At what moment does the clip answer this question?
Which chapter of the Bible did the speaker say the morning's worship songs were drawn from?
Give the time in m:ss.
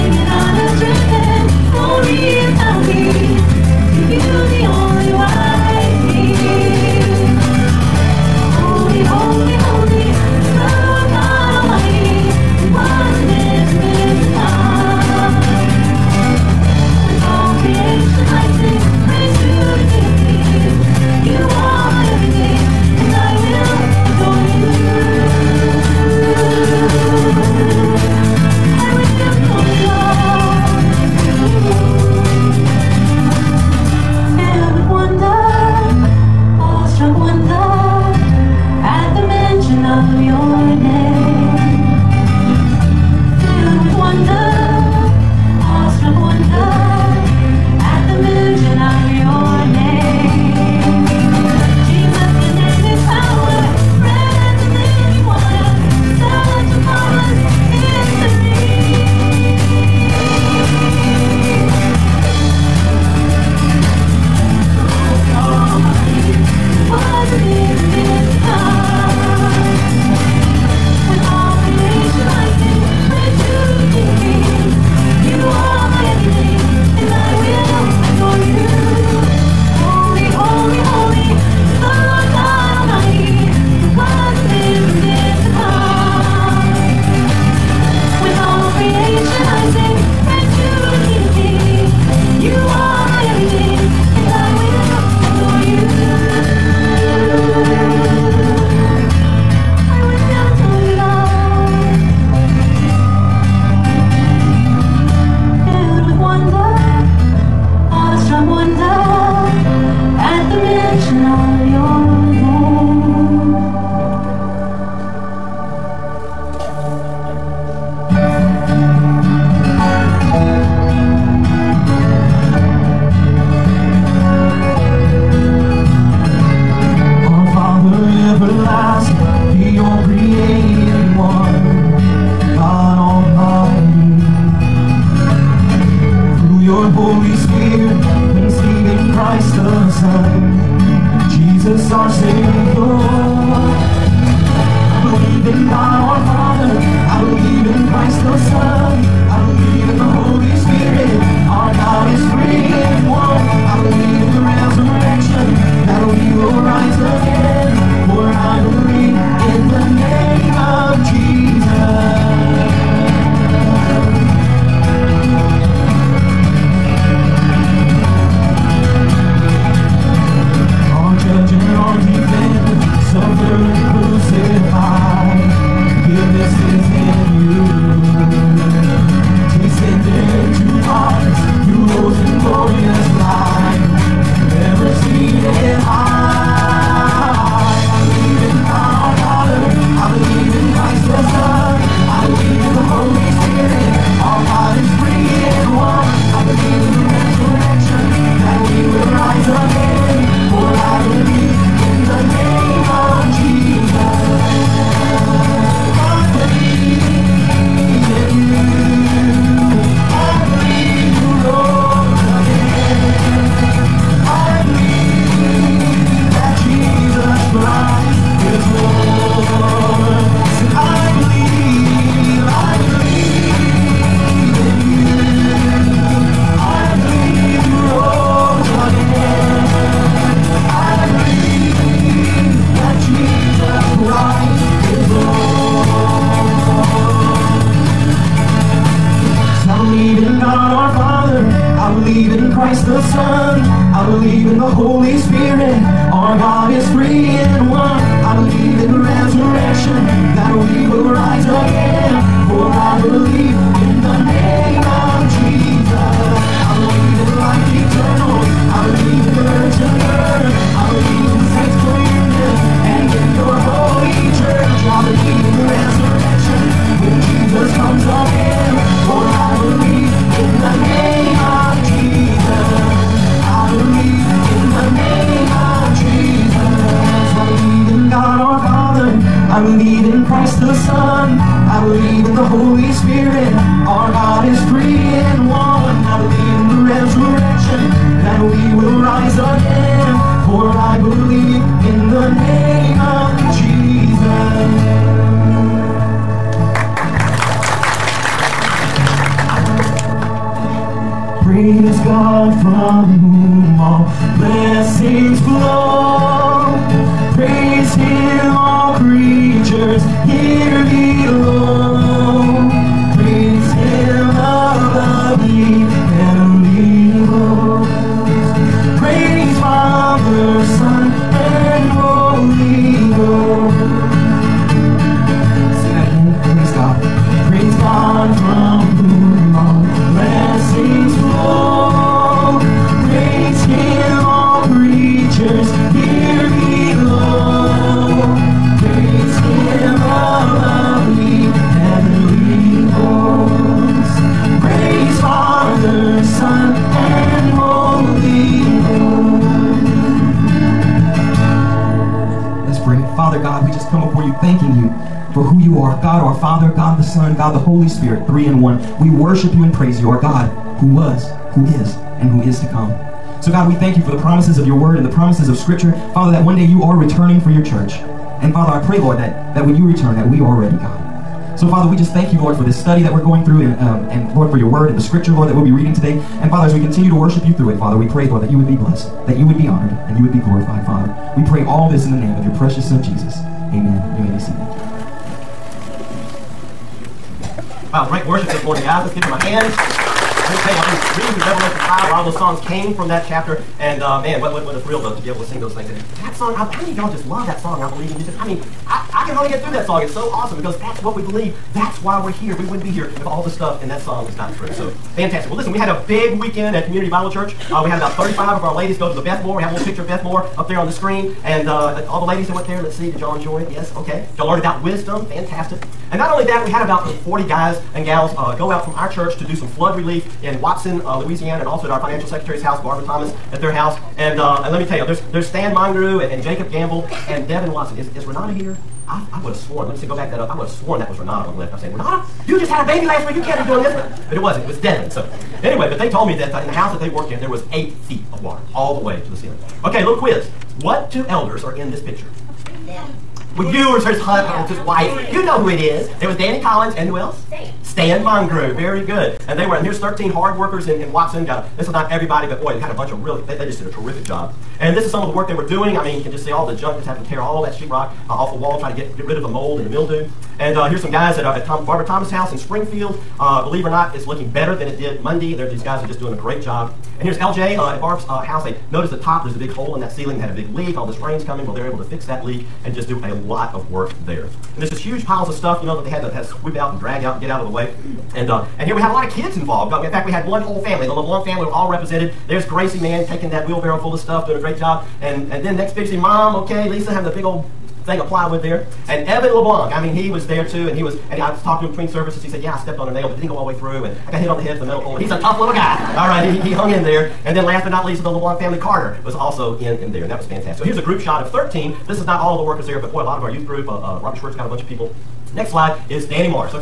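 6:31.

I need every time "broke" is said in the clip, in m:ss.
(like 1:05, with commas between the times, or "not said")
not said.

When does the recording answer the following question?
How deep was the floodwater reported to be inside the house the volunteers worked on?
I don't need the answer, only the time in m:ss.
7:17.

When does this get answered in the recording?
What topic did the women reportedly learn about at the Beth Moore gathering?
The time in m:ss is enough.
6:54.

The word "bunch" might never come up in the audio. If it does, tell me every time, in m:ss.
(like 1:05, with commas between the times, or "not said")
7:32, 8:24.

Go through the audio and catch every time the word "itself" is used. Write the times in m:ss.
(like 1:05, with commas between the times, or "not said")
not said.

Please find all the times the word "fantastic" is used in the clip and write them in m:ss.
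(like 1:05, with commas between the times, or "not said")
6:45, 6:55, 8:20.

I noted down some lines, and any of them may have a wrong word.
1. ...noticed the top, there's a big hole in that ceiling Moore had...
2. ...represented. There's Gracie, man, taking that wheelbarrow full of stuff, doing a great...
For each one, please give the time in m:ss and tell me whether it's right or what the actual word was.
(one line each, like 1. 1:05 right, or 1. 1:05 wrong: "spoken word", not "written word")
1. 7:48 wrong: "They", not "Moore"
2. 8:01 right.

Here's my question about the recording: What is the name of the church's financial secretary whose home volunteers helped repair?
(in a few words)
Barbara Thomas.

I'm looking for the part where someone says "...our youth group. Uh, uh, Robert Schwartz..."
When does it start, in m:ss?
8:23.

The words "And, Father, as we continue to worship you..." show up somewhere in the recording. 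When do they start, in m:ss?
6:16.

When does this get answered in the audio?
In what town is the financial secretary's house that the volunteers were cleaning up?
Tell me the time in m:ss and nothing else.
7:42.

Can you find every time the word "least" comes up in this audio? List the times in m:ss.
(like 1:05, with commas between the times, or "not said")
8:18.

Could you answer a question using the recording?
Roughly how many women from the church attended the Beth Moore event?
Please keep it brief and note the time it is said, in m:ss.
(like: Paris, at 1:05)
35, at 6:48.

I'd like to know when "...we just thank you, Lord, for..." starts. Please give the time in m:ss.
6:11.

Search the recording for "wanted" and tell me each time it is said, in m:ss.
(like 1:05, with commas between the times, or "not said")
not said.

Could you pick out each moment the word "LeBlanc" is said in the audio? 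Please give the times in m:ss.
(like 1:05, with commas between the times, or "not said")
8:01, 8:09, 8:18.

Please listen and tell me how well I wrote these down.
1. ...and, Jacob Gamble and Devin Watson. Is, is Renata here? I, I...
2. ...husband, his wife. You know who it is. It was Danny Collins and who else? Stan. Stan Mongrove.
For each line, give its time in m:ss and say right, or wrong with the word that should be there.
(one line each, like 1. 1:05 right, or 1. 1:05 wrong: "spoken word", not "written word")
1. 7:06 right
2. 7:24 right.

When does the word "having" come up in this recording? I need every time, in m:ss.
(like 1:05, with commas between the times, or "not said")
7:37, 8:07.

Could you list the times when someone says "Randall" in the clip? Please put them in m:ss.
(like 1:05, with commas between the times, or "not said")
not said.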